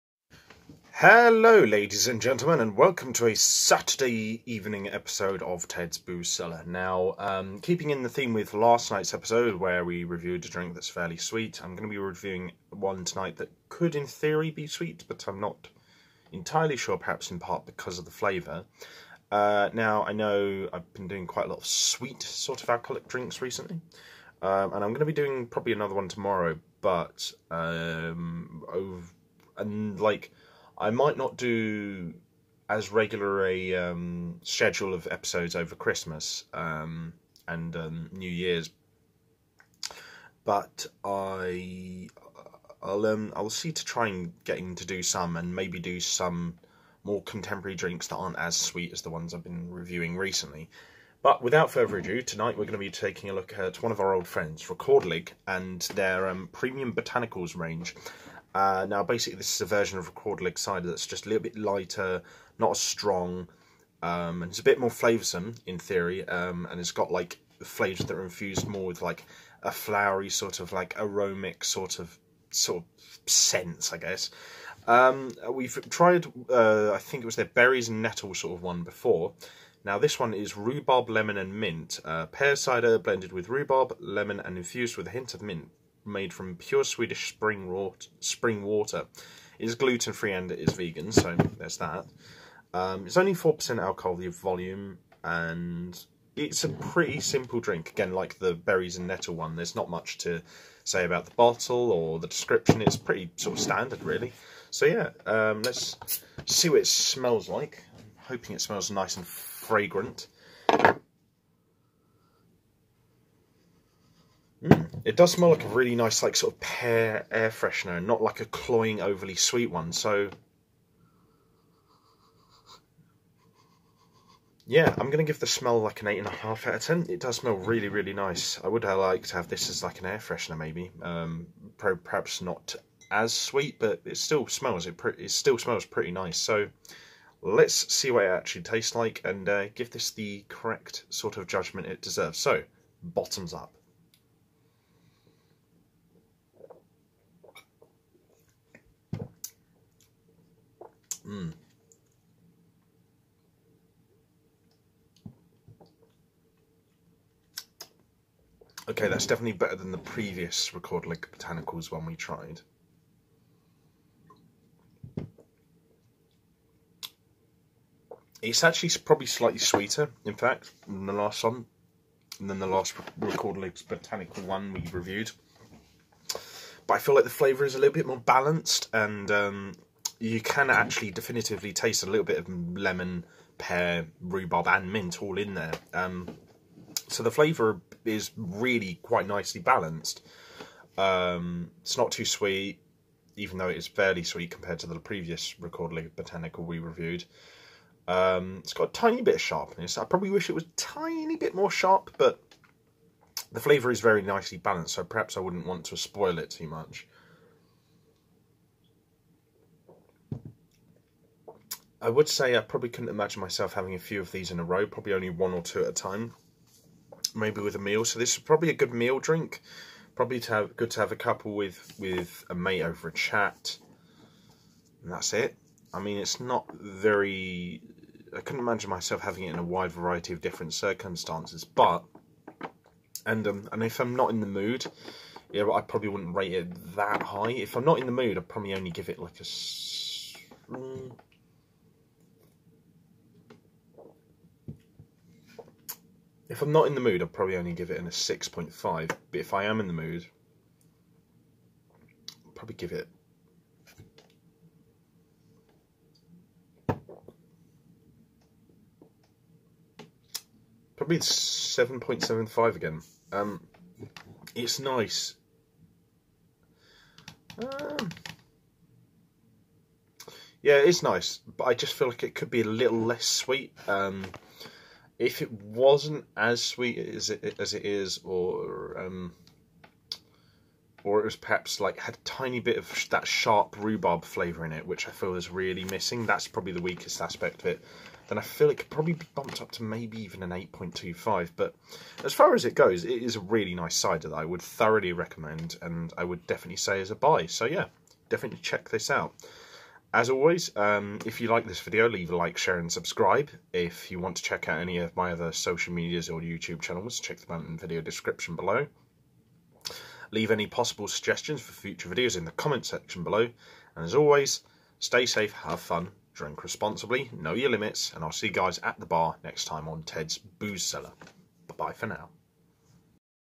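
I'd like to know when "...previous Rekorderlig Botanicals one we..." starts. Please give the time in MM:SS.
02:39.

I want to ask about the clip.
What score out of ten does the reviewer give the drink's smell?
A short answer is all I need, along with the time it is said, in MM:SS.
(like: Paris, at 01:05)
8.5, at 02:06.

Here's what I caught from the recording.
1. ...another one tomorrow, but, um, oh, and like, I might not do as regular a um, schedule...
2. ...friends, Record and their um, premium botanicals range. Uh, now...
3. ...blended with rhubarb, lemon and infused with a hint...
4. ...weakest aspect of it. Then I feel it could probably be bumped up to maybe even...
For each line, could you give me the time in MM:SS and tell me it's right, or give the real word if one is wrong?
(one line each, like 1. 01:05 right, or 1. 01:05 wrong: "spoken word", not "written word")
1. 00:25 right
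2. 00:54 right
3. 01:22 right
4. 04:46 right.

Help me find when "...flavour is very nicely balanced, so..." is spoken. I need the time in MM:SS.
03:23.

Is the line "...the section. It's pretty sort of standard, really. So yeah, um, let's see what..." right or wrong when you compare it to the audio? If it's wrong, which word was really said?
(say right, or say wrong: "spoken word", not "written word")
wrong: "description", not "section".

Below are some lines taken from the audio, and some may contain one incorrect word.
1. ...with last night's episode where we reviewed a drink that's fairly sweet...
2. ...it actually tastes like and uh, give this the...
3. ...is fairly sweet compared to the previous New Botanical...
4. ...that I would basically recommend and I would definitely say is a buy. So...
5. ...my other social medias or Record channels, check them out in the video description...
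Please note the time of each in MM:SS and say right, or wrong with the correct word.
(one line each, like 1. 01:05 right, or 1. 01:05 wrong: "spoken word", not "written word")
1. 00:08 right
2. 02:18 right
3. 03:13 wrong: "Rekorderlig", not "New"
4. 04:54 wrong: "thoroughly", not "basically"
5. 05:05 wrong: "YouTube", not "Record".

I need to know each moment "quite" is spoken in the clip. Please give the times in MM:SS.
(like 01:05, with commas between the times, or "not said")
00:21, 03:09.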